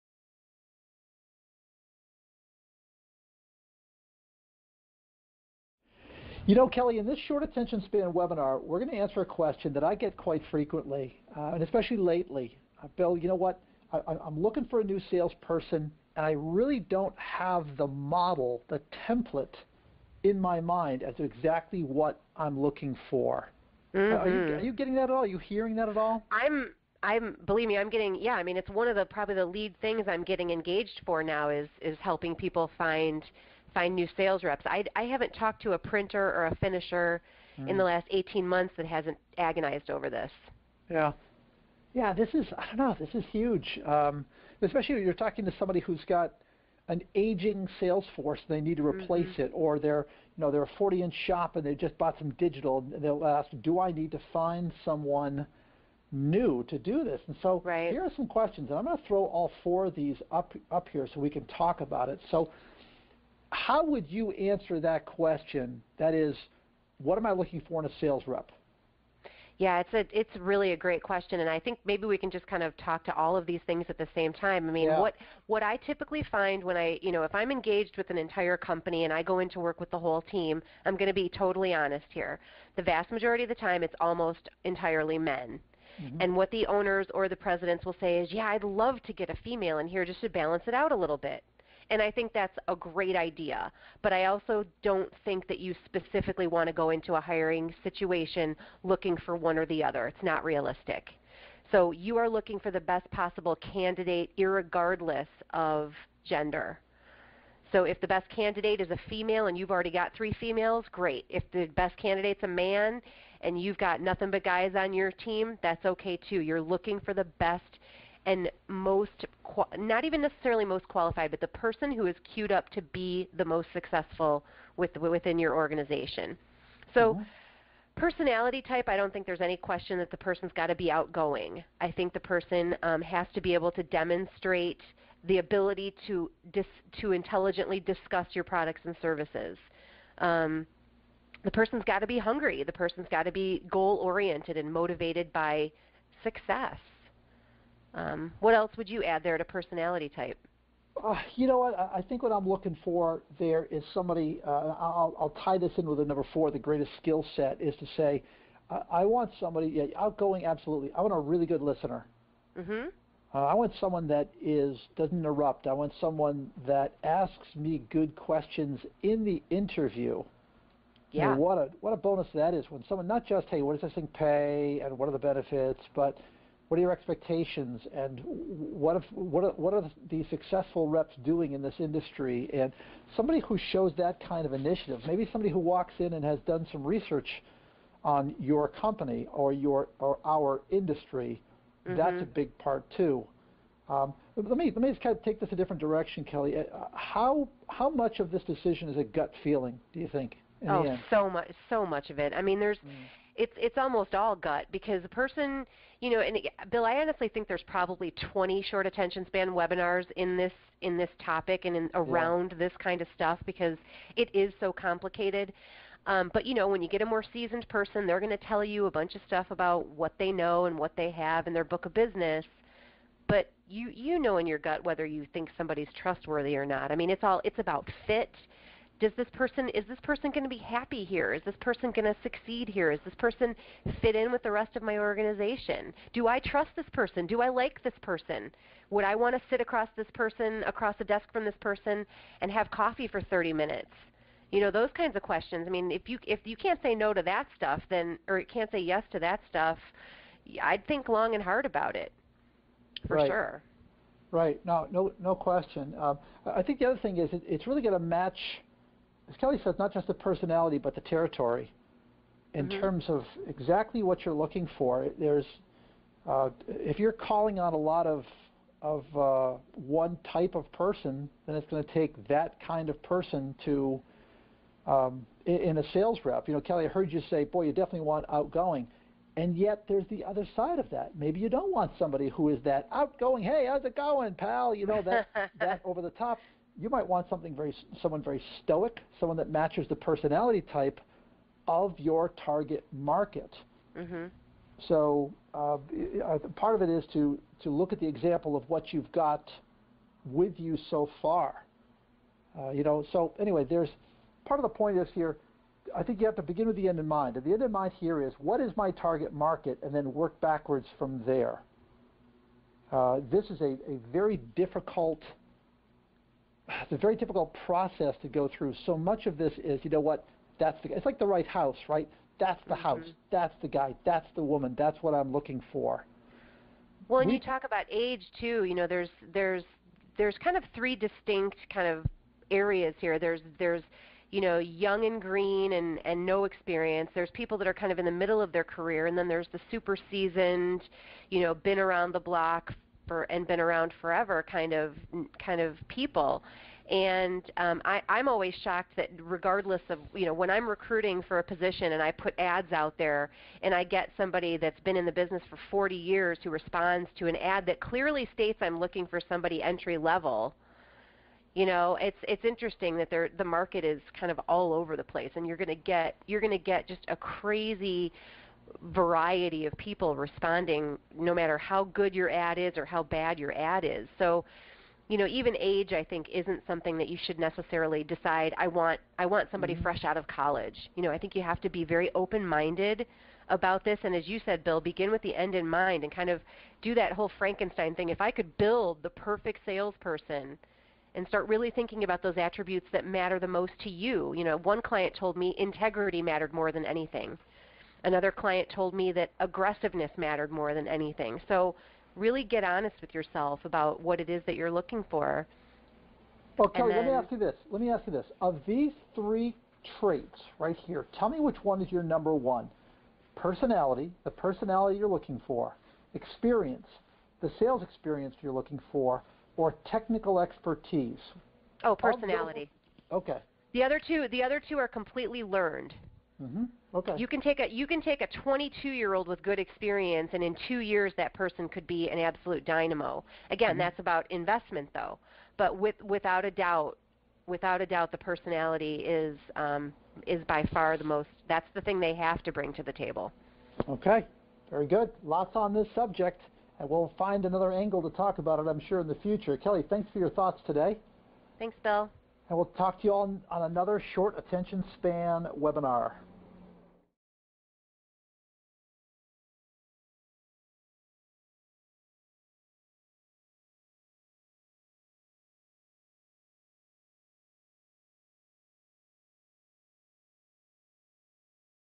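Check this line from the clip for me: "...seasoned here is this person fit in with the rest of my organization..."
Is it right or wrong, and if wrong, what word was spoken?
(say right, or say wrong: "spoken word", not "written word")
wrong: "succeed", not "seasoned".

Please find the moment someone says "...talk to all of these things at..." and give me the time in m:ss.
1:12.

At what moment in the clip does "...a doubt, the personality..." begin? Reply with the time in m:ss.
7:17.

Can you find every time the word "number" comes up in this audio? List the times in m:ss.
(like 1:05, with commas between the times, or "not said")
2:36, 6:52.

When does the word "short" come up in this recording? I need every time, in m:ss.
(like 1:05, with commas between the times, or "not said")
0:07, 3:28, 7:34.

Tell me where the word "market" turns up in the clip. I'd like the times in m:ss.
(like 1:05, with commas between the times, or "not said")
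4:52, 5:09, 6:03.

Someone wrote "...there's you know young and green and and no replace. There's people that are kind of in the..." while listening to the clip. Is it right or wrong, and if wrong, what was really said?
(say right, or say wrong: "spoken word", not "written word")
wrong: "experience", not "replace".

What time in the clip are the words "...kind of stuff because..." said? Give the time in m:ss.
3:32.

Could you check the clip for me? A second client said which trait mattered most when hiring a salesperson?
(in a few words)
Aggressiveness.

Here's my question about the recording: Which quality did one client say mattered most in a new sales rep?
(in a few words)
Integrity.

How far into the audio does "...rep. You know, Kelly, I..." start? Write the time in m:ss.
4:36.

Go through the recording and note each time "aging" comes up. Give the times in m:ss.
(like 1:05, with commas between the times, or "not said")
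0:47.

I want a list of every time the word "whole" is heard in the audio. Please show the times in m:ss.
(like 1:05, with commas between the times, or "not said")
1:19, 6:27.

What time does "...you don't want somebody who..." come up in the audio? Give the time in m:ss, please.
4:41.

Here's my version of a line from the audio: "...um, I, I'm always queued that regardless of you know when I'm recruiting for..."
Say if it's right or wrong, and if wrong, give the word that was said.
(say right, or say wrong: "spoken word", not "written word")
wrong: "shocked", not "queued".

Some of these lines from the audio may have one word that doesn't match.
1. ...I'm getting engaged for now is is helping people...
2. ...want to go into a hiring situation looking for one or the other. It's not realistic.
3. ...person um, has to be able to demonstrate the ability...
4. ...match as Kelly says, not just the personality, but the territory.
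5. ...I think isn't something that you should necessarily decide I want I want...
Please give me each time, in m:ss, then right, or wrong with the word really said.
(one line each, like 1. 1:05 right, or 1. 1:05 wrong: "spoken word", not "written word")
1. 0:30 right
2. 1:36 right
3. 2:12 right
4. 4:17 right
5. 6:15 right.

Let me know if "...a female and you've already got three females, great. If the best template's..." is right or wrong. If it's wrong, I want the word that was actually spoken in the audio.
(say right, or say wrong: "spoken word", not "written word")
wrong: "candidate", not "template".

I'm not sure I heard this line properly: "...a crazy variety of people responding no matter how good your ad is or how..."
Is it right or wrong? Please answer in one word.
right.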